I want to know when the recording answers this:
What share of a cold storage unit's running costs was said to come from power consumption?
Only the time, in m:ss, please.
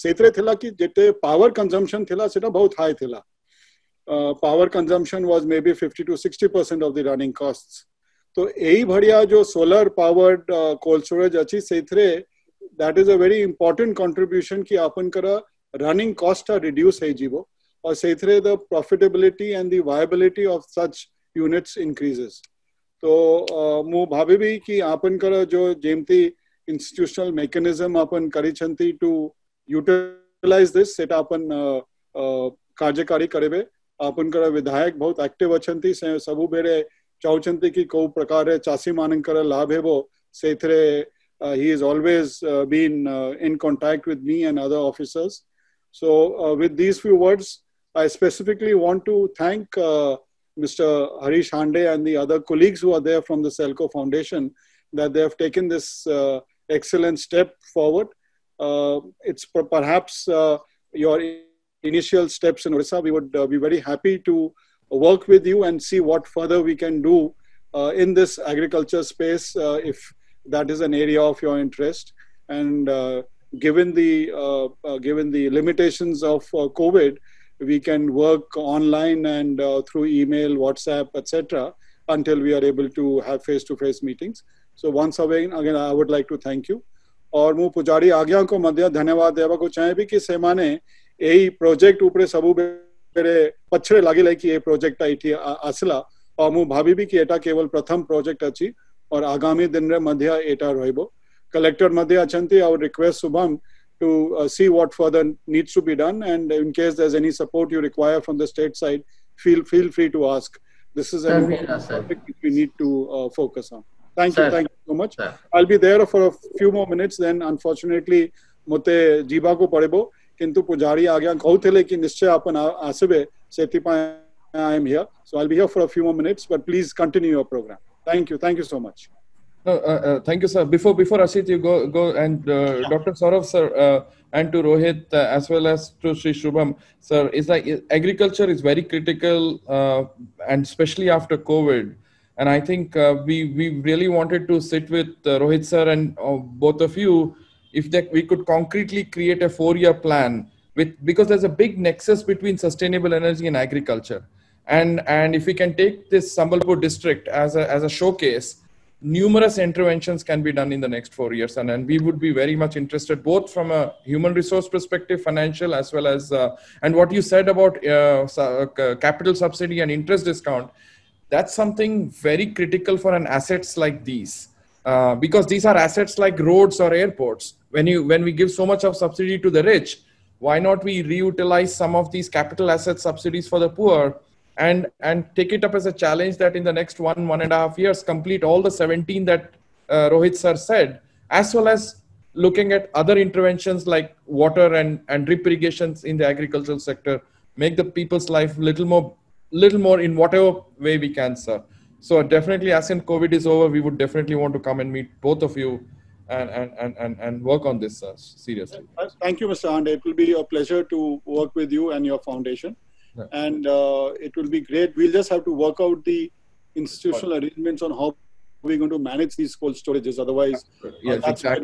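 0:05.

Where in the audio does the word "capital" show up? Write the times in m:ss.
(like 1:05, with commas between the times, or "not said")
2:48, 3:02.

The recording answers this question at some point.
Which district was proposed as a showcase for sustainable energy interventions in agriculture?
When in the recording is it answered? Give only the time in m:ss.
2:36.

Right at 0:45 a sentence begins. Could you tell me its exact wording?
So, uh, with these few words, I specifically want to thank Mr.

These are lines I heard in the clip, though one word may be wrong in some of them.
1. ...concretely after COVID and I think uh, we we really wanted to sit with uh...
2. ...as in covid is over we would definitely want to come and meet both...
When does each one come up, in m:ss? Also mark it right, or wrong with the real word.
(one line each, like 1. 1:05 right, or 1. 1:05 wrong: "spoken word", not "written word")
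1. 2:20 wrong: "especially", not "concretely"
2. 3:22 right.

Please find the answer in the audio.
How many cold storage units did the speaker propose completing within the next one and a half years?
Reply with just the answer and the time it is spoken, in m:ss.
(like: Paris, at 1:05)
17, at 3:08.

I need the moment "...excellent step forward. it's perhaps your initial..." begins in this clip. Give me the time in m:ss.
0:56.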